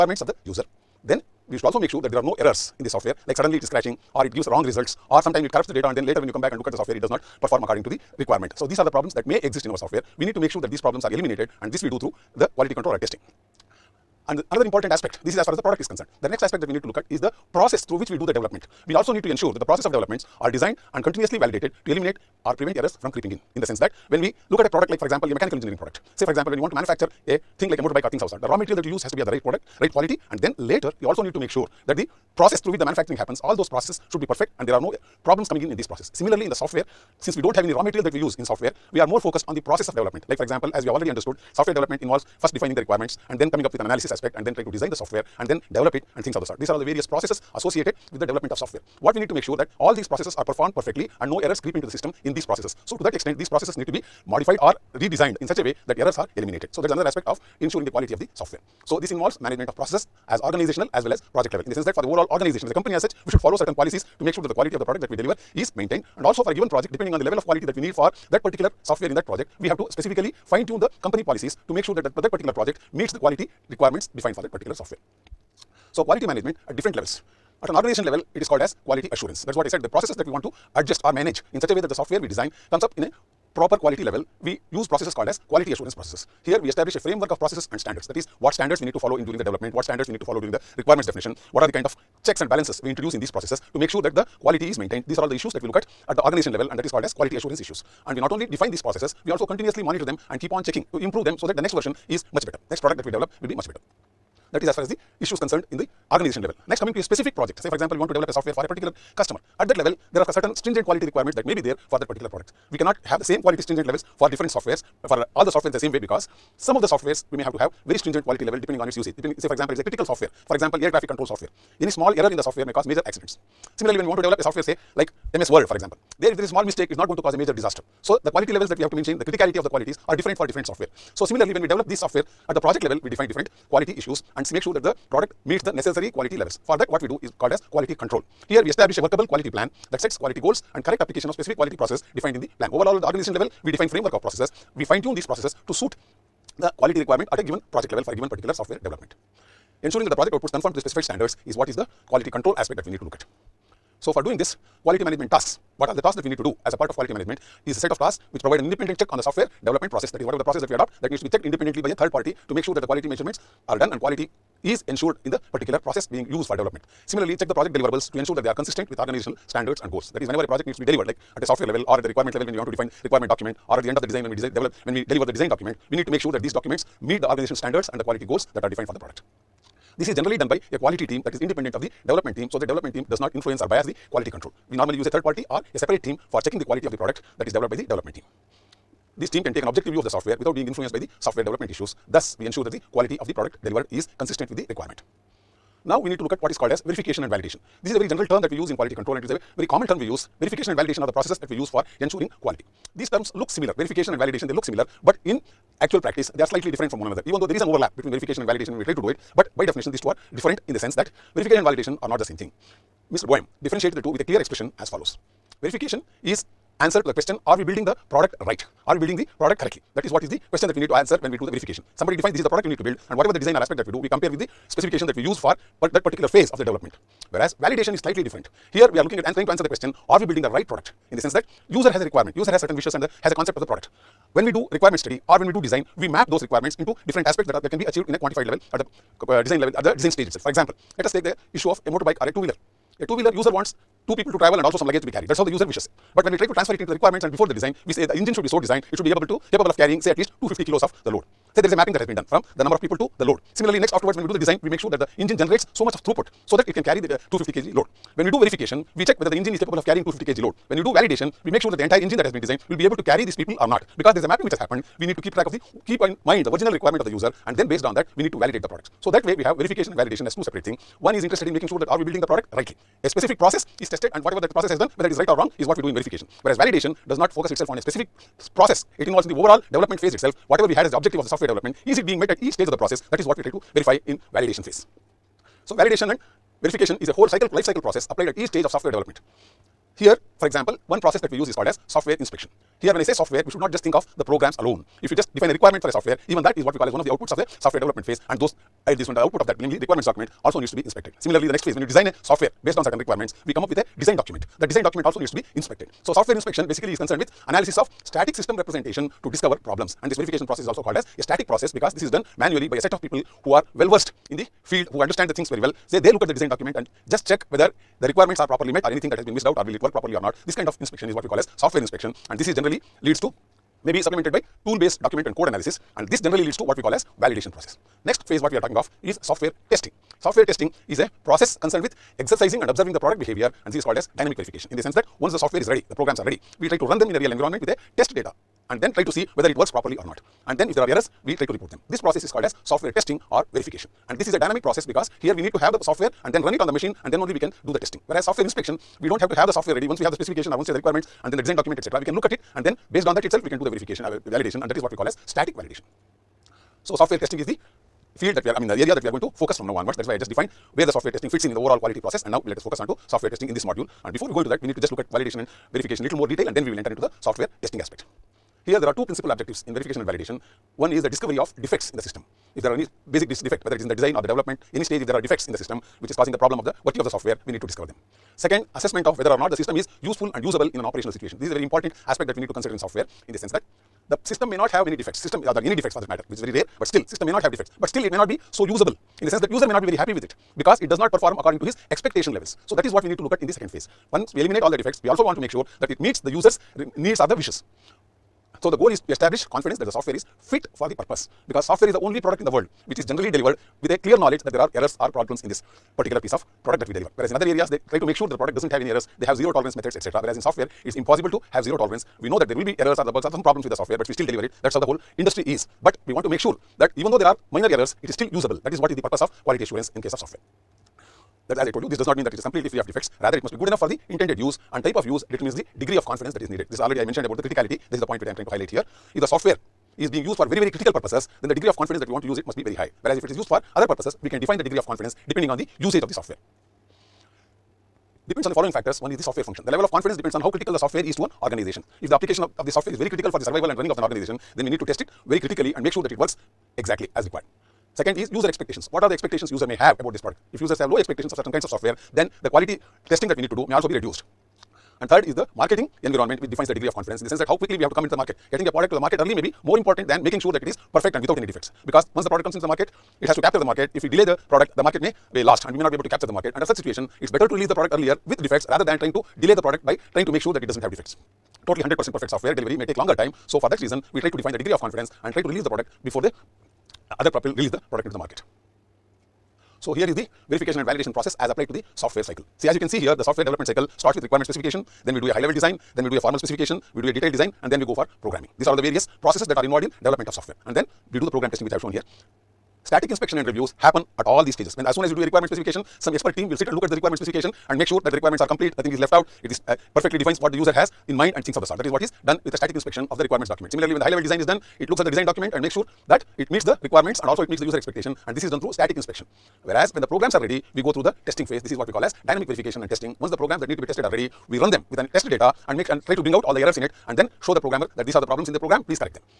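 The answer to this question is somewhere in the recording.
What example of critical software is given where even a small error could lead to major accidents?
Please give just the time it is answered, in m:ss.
2:00.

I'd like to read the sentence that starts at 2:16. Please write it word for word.
For that, what we do is called as quality control.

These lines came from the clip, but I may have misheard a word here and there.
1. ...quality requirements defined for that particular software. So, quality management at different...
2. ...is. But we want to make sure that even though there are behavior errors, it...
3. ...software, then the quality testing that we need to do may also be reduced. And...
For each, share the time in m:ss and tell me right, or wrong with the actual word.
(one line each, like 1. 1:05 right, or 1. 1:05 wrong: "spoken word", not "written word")
1. 1:13 right
2. 6:55 wrong: "minor", not "behavior"
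3. 7:31 right.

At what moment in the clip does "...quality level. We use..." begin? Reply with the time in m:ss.
1:23.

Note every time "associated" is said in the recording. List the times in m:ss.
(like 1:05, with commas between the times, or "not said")
0:47.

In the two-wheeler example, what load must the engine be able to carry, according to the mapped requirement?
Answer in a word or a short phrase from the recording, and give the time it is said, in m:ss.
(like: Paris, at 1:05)
250 kilos, at 4:10.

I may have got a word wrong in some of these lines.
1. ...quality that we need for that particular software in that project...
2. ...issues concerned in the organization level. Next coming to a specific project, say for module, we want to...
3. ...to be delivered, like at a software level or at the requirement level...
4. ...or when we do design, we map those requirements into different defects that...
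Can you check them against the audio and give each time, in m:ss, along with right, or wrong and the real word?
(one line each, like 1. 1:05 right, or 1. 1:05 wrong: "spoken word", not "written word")
1. 1:07 right
2. 1:45 wrong: "example", not "module"
3. 2:50 right
4. 3:55 wrong: "aspects", not "defects".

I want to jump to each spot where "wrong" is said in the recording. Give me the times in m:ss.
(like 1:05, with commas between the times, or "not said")
0:04, 4:35.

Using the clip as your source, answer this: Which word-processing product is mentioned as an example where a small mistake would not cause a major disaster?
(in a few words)
MS Word.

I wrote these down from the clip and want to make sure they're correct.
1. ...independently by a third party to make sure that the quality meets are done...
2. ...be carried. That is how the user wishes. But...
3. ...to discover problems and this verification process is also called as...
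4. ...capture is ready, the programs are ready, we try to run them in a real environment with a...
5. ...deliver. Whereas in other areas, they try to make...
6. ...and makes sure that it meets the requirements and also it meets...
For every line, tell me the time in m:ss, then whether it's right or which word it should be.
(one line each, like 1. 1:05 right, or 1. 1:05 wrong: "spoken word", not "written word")
1. 2:41 wrong: "measurements", not "meets"
2. 4:05 right
3. 5:09 right
4. 5:35 wrong: "software", not "capture"
5. 6:46 right
6. 8:25 right.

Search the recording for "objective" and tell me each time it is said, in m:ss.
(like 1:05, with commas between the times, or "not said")
3:09, 4:40, 6:09.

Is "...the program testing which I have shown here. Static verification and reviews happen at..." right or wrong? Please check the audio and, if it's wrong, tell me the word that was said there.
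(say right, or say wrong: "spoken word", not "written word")
wrong: "inspection", not "verification".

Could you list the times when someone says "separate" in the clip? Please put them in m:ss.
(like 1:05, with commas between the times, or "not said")
3:05, 4:30.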